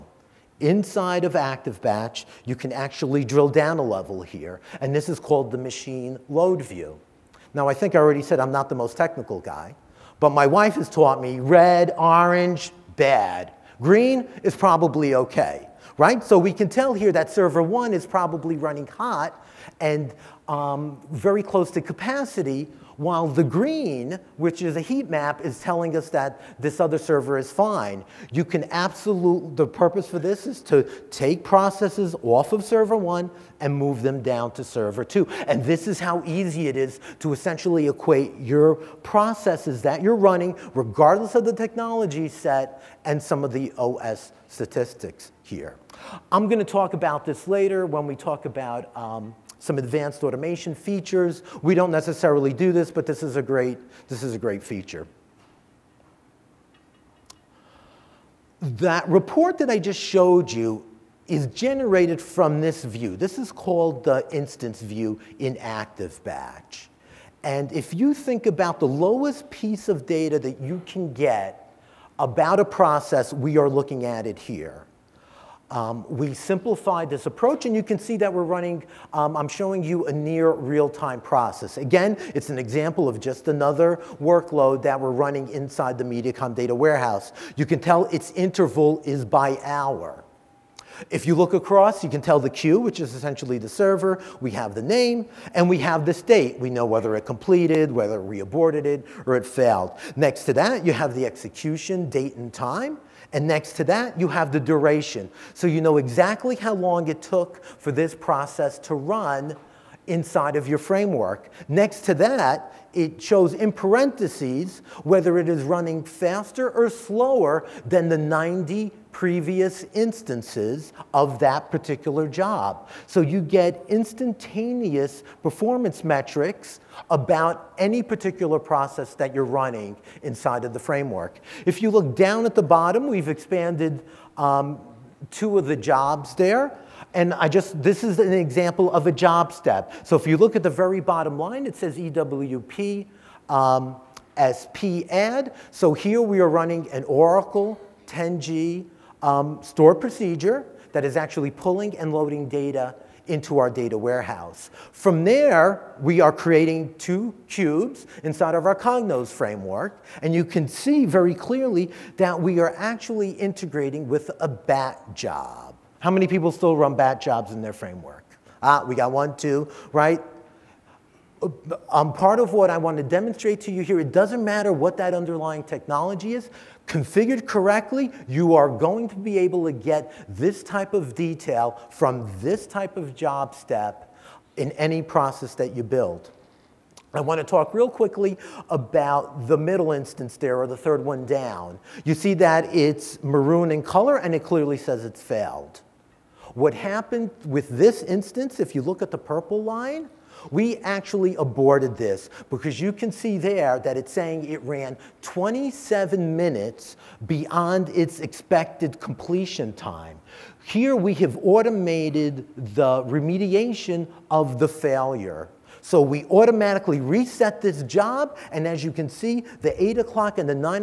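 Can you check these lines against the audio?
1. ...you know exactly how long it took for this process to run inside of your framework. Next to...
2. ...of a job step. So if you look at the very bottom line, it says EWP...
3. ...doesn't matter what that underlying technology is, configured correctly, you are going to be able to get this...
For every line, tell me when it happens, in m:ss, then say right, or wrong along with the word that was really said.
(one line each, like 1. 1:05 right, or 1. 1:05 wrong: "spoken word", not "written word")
1. 1:45 right
2. 2:18 right
3. 2:54 right.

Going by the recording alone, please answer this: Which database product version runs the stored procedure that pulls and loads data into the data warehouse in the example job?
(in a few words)
Oracle 10G.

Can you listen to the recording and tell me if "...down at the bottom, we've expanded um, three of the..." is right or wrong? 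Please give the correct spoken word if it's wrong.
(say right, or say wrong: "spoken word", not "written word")
wrong: "two", not "three".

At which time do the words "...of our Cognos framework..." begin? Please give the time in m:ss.
2:38.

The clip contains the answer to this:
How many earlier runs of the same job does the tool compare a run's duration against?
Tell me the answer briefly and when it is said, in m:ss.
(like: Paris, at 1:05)
90, at 1:58.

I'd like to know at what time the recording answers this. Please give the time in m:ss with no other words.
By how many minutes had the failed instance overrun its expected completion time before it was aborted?
3:25.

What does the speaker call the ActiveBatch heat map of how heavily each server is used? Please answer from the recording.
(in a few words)
machine load view.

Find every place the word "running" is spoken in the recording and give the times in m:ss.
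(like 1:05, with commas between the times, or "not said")
0:18, 0:40, 1:18, 1:25, 1:55, 2:09, 2:26.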